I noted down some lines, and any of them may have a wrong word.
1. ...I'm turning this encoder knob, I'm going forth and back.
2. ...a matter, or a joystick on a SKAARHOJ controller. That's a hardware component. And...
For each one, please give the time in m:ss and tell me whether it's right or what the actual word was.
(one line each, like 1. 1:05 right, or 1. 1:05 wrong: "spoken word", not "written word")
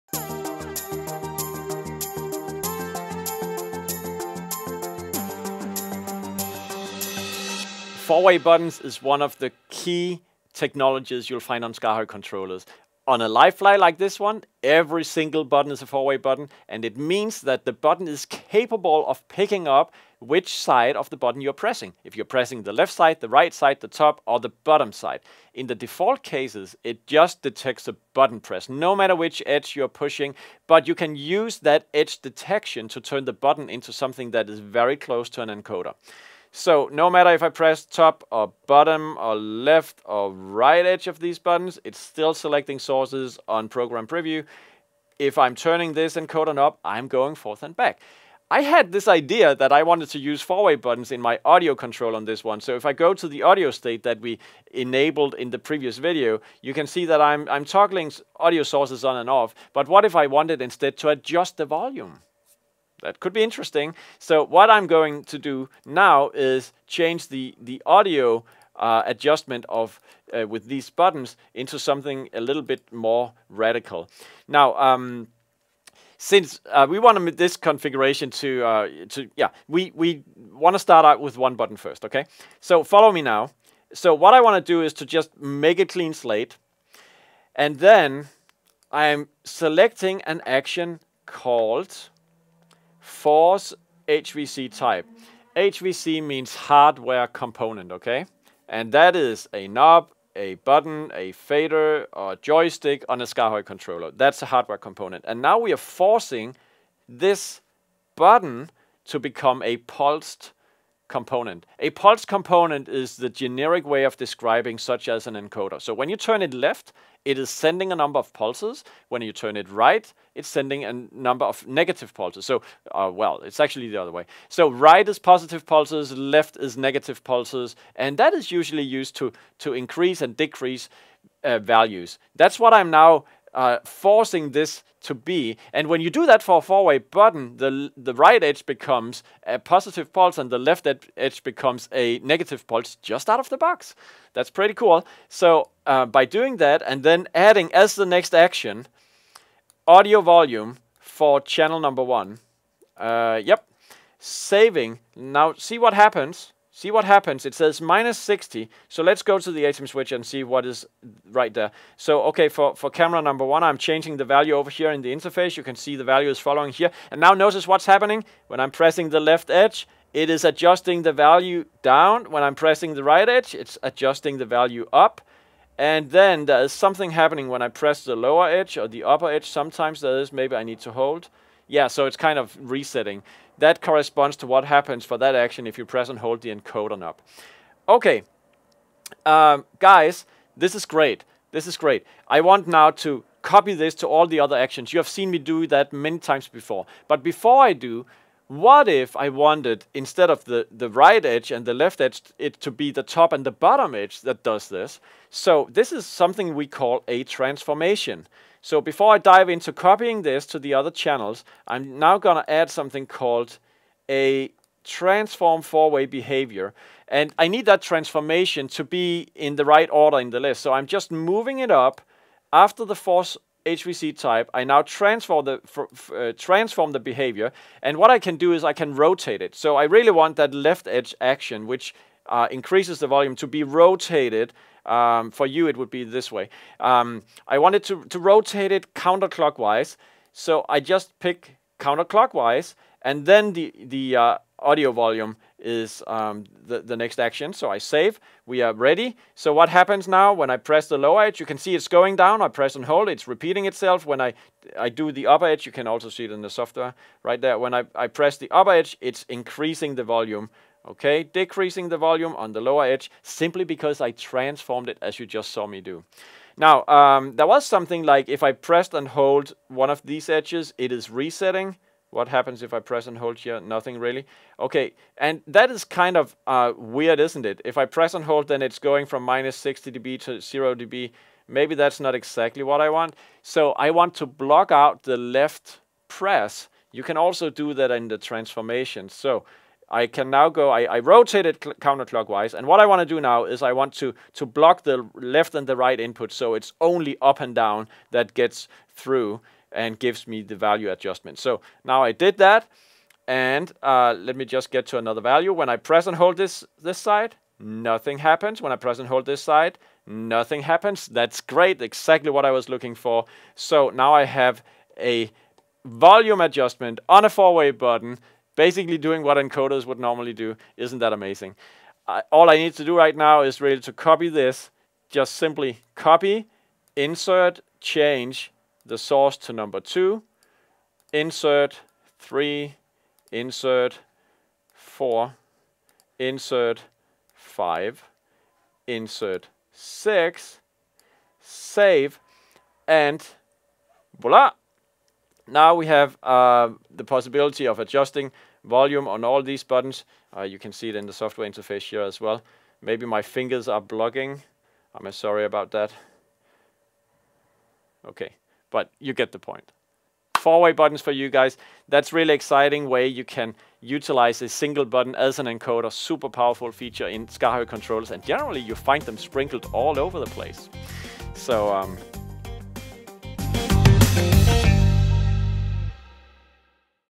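1. 0:45 right
2. 1:41 wrong: "fader", not "matter".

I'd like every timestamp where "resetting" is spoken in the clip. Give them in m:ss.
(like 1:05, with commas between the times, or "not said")
3:02, 4:31.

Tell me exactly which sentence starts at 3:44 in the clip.
I now transform the, uh, transform the behavior.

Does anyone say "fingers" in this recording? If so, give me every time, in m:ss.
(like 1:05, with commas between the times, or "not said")
5:53.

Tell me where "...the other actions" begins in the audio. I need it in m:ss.
3:14.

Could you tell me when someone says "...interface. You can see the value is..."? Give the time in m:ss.
2:45.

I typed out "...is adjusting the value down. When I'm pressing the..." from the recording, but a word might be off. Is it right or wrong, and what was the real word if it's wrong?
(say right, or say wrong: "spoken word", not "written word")
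right.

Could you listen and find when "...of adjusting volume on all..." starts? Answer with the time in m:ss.
5:47.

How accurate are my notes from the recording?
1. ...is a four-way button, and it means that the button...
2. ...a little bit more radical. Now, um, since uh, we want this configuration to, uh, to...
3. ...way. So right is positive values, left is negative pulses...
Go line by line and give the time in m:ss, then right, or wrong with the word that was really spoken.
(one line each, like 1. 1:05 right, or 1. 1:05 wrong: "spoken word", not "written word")
1. 0:15 right
2. 1:12 right
3. 2:04 wrong: "pulses", not "values".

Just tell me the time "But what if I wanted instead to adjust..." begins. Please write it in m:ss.
0:59.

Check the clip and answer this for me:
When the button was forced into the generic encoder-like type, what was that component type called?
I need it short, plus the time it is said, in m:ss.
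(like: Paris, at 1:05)
Pulsed component, at 1:49.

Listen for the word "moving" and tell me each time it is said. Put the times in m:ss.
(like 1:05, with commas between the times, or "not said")
3:41.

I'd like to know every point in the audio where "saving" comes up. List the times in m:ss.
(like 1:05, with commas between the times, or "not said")
2:34.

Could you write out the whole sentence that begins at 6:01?
That's really exciting way you can utilize a single button as an encoder.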